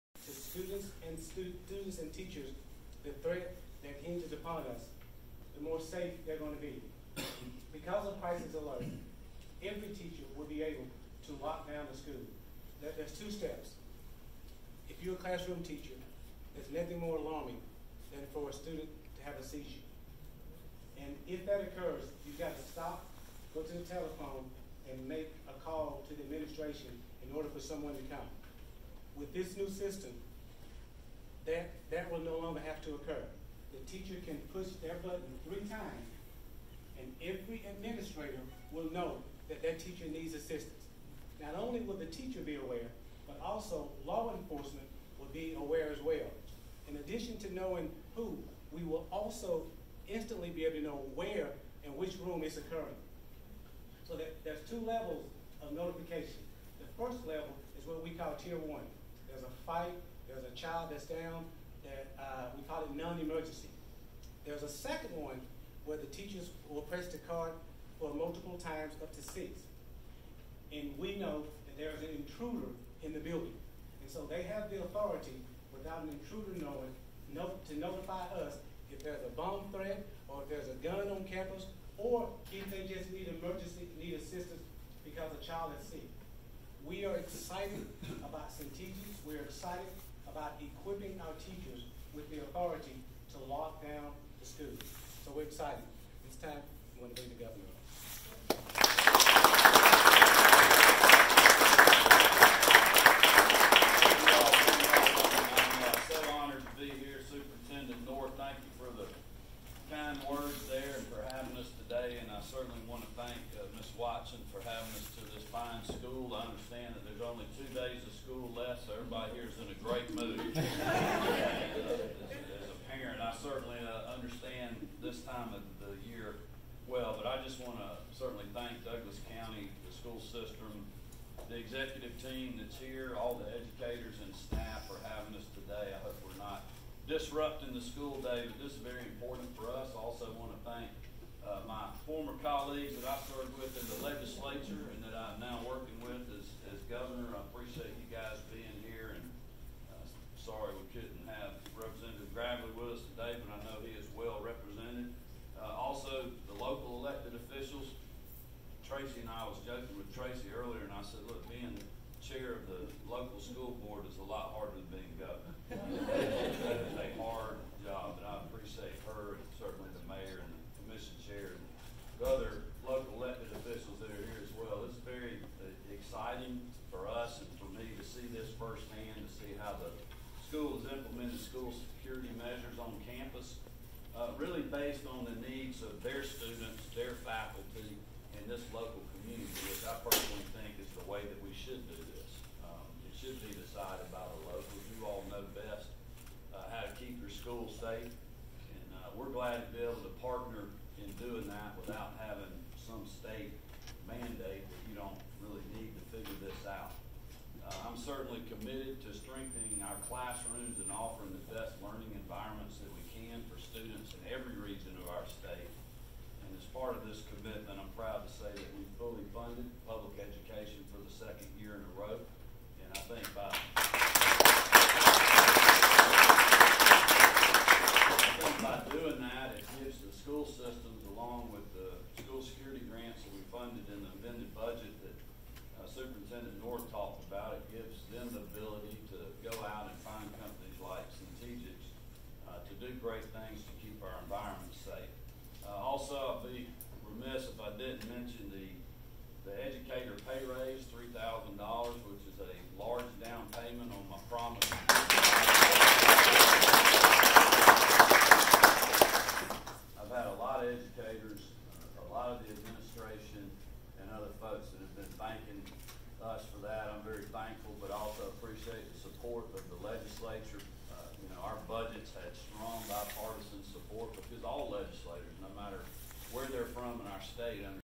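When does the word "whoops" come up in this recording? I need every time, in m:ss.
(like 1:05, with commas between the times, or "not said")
not said.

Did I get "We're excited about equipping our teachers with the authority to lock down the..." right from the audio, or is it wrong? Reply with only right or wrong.
right.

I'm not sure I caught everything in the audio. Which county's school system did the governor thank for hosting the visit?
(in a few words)
Douglas County.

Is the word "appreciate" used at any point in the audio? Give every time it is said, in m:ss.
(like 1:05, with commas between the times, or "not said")
2:48, 4:28.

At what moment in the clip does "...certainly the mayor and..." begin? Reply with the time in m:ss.
2:49.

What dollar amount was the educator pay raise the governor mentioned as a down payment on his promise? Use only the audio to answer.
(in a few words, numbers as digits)
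$3,000.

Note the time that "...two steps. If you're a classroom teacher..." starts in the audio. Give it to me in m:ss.
0:13.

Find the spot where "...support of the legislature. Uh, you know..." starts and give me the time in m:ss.
4:29.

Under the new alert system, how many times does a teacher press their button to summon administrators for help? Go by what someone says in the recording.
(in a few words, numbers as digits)
3.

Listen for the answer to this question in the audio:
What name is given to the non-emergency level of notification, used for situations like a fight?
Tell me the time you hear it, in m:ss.
0:58.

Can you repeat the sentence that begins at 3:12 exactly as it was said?
Um, it should be decided by the locals.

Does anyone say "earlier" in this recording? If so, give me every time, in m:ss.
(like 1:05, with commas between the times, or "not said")
2:40.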